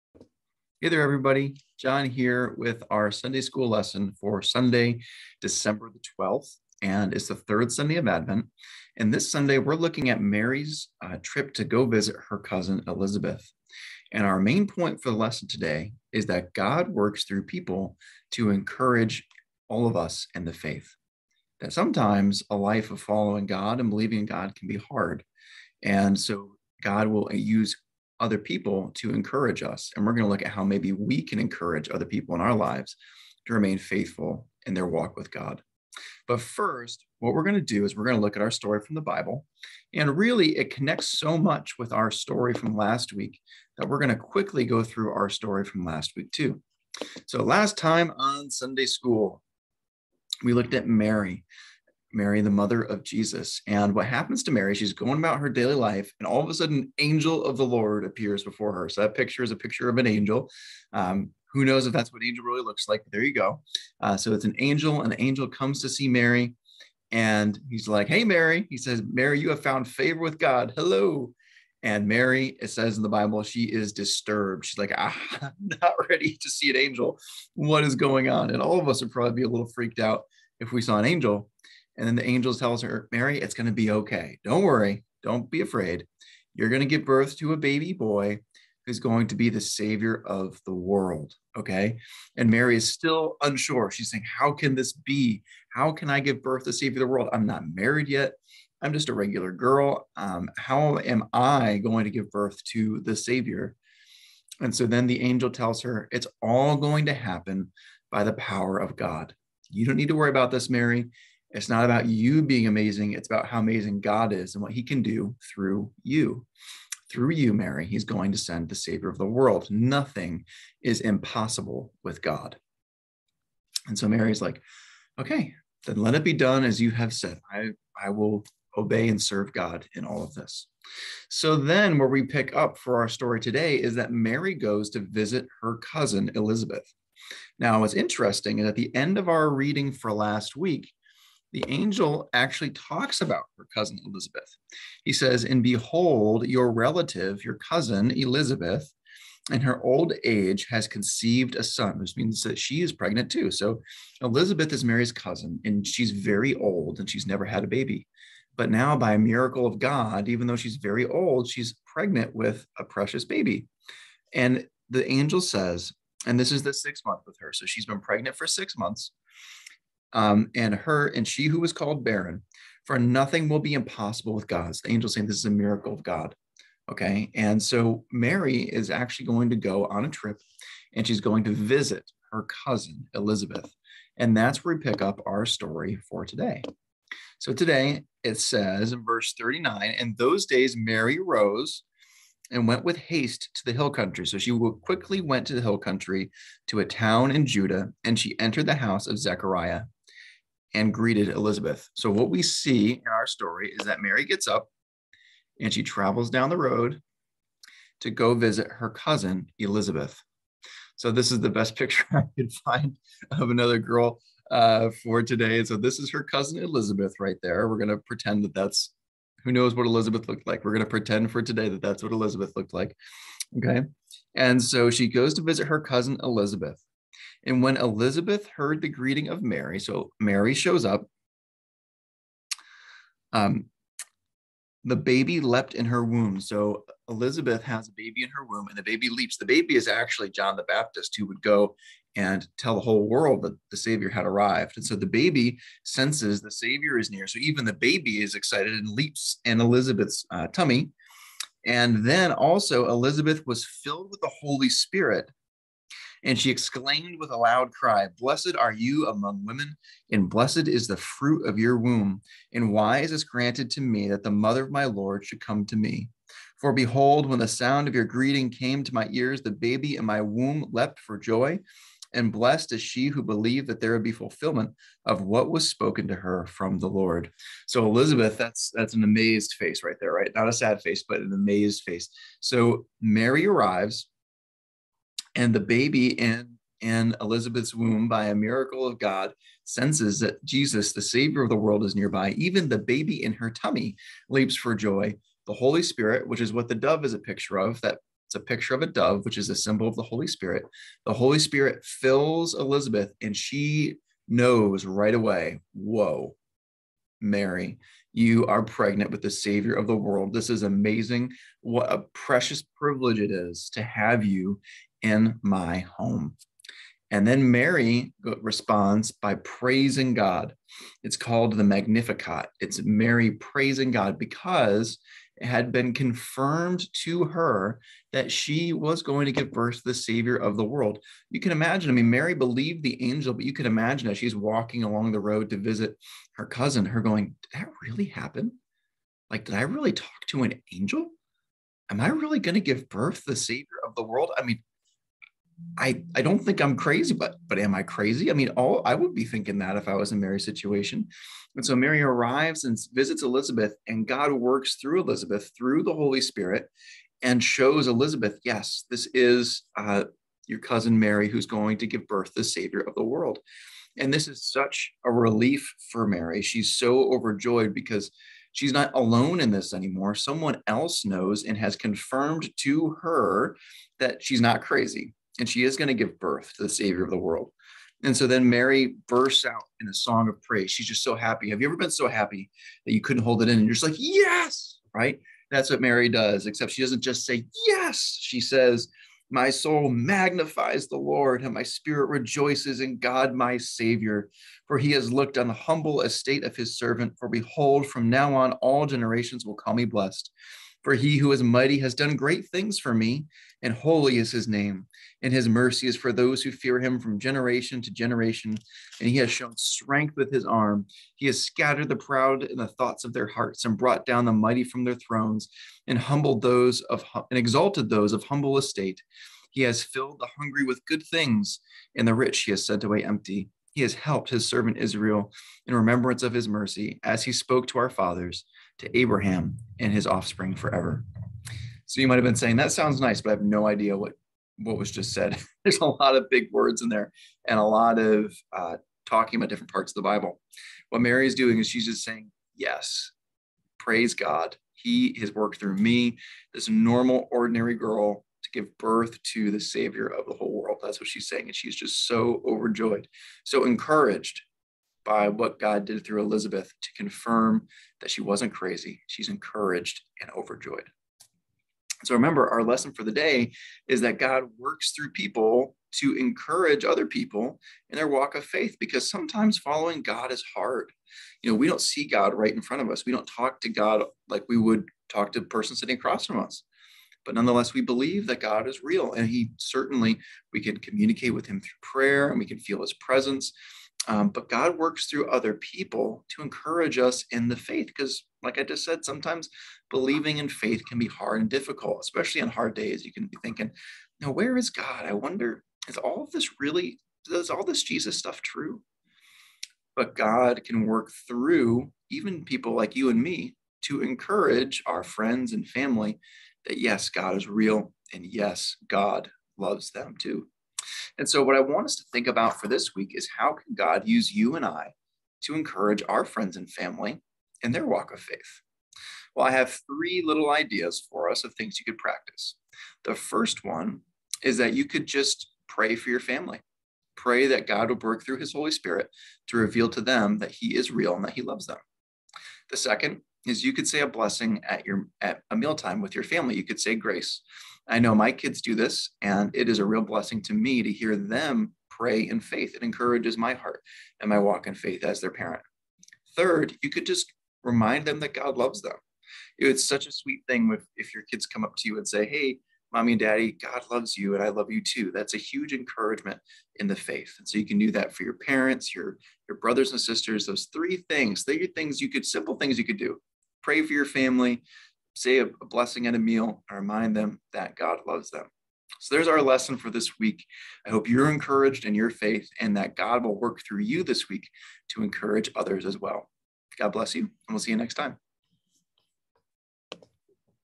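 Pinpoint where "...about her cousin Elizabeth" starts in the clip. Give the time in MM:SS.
02:23.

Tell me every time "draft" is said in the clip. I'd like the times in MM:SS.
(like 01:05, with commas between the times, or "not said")
not said.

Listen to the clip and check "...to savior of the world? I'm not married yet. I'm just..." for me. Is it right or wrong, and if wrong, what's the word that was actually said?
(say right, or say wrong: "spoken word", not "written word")
right.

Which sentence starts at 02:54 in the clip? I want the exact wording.
the angel saying this is a miracle of God.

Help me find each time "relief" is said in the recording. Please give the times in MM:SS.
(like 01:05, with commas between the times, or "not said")
06:05.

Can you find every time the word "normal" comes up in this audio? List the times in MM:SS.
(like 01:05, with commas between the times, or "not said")
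07:26.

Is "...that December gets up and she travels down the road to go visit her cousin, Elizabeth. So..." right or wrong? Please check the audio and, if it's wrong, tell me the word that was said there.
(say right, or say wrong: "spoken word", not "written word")
wrong: "Mary", not "December".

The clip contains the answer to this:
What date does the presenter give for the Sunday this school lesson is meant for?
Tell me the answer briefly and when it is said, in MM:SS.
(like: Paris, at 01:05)
December 12th, at 00:05.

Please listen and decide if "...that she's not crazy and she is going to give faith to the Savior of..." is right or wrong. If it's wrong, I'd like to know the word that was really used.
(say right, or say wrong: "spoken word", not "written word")
wrong: "birth", not "faith".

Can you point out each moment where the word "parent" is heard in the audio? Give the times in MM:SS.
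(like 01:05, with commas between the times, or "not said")
09:05, 09:18.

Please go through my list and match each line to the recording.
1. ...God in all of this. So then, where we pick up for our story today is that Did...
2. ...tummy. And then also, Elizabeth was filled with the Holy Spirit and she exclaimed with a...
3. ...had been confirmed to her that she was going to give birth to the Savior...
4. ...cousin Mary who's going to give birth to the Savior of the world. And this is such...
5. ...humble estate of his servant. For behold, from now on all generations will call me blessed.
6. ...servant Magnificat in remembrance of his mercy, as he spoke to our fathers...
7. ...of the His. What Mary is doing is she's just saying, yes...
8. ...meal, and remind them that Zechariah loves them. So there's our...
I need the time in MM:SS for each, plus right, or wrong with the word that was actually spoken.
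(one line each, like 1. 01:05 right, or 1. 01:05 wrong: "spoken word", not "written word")
1. 02:09 wrong: "Mary", not "Did"
2. 04:10 right
3. 05:25 right
4. 06:00 right
5. 06:35 right
6. 07:04 wrong: "Israel", not "Magnificat"
7. 07:19 wrong: "Bible", not "His"
8. 09:26 wrong: "God", not "Zechariah".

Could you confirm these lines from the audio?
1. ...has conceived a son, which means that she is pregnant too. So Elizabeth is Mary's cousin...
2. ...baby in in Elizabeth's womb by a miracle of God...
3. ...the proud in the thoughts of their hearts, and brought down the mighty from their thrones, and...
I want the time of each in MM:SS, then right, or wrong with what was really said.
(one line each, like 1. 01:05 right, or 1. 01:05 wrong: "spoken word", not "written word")
1. 02:30 right
2. 04:45 right
3. 06:51 right.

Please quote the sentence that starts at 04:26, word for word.
For behold, when the sound of your greeting came to my ears, the baby in my womb leapt for joy.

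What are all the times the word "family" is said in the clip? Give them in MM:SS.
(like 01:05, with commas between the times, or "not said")
08:25, 08:36, 08:46, 08:56, 09:24.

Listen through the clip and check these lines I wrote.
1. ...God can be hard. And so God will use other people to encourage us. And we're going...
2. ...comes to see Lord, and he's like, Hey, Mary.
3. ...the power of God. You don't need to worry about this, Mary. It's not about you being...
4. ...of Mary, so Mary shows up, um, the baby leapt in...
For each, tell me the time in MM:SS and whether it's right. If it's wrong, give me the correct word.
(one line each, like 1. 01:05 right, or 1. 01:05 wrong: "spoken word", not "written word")
1. 00:24 right
2. 01:05 wrong: "Mary", not "Lord"
3. 01:48 right
4. 03:49 right.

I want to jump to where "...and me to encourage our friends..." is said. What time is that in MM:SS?
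08:23.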